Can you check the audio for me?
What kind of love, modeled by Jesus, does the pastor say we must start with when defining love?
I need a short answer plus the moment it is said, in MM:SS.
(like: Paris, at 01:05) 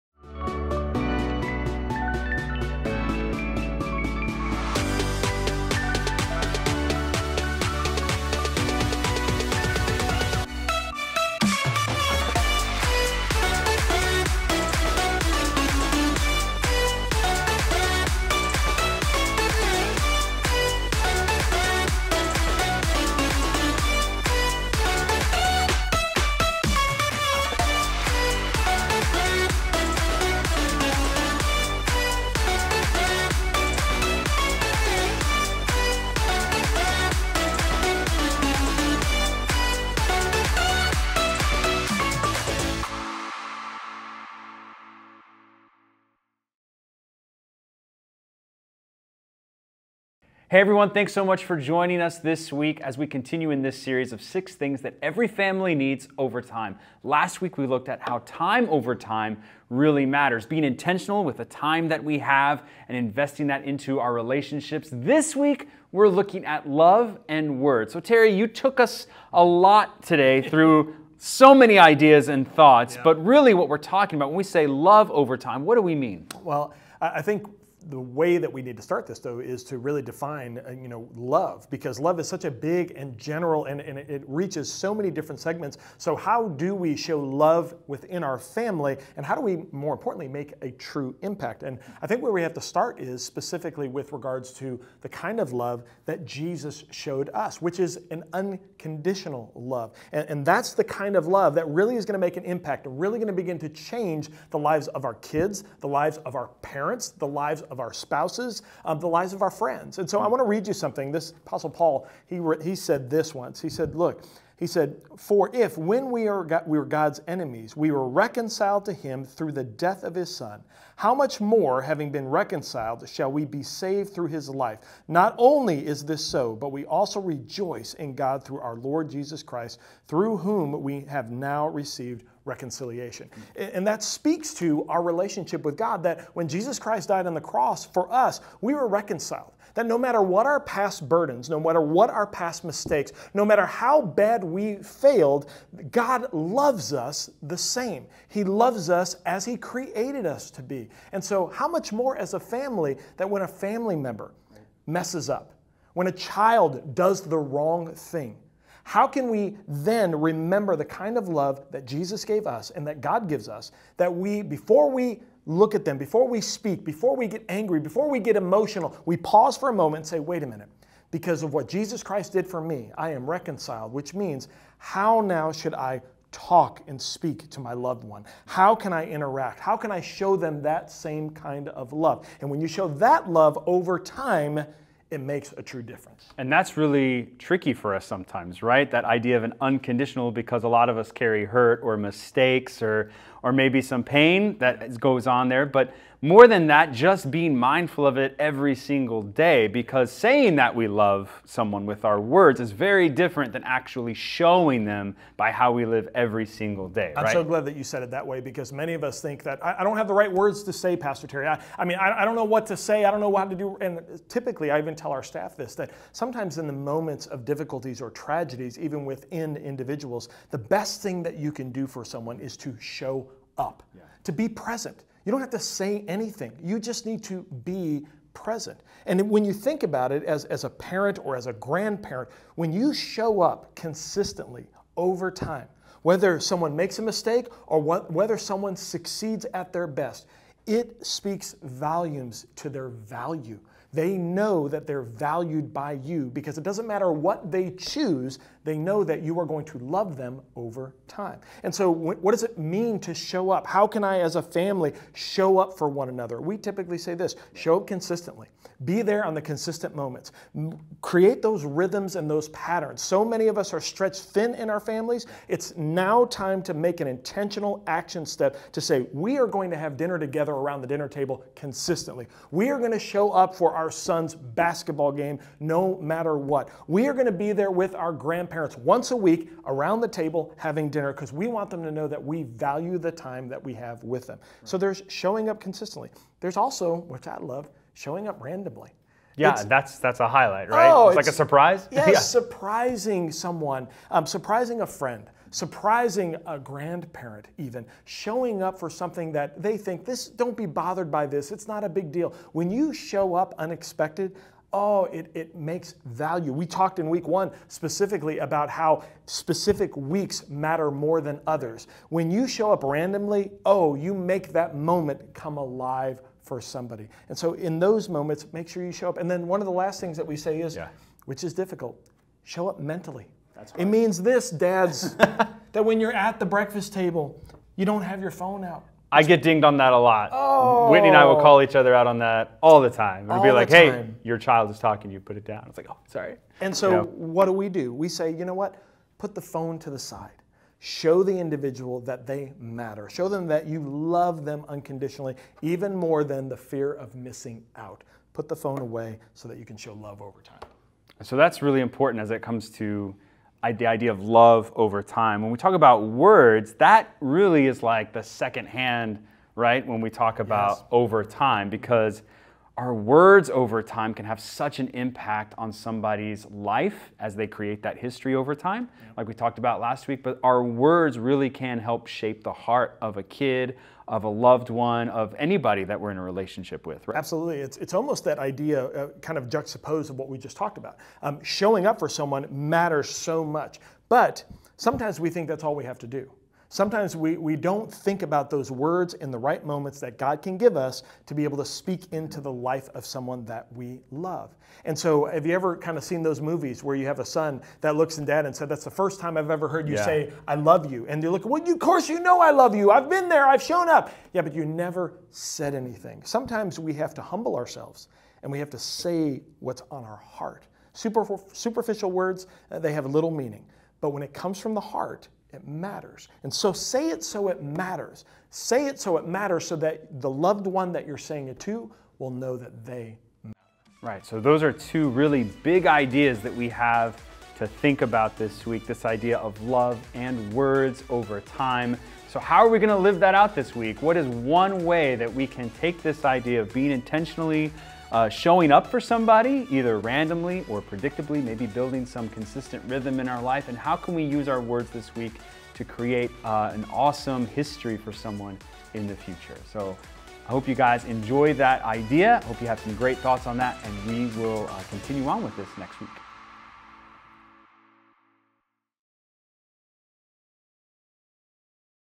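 unconditional love, at 01:38.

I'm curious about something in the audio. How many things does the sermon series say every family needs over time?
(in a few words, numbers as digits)
6.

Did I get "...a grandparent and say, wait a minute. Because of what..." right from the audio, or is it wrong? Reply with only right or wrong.
wrong.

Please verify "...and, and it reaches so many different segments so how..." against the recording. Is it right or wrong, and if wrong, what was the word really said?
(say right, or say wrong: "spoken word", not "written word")
right.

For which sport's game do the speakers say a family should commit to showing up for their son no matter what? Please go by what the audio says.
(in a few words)
basketball.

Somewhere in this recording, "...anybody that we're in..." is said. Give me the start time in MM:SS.
06:15.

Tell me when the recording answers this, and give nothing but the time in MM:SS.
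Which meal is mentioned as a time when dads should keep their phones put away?
05:26.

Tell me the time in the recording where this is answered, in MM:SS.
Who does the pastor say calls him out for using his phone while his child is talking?
05:30.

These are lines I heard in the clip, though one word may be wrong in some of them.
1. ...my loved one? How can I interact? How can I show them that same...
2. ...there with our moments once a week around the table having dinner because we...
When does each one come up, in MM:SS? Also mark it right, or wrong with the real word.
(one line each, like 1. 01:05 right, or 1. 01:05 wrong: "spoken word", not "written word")
1. 02:57 right
2. 04:37 wrong: "grandparents", not "moments".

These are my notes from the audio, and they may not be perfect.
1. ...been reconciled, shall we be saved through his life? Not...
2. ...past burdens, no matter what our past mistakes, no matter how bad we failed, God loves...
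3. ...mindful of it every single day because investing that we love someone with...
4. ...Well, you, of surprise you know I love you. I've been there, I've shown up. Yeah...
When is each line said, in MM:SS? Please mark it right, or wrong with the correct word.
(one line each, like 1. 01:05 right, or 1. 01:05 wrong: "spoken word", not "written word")
1. 02:02 right
2. 02:20 right
3. 03:17 wrong: "saying", not "investing"
4. 06:41 wrong: "course", not "surprise".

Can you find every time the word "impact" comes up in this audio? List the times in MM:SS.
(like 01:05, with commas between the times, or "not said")
01:31, 01:42, 06:04.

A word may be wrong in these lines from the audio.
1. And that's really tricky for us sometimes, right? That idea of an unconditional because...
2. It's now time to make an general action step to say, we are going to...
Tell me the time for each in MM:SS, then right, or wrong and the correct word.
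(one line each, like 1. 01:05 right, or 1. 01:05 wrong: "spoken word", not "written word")
1. 03:06 right
2. 04:25 wrong: "intentional", not "general".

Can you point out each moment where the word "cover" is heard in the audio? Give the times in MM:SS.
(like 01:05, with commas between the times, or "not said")
not said.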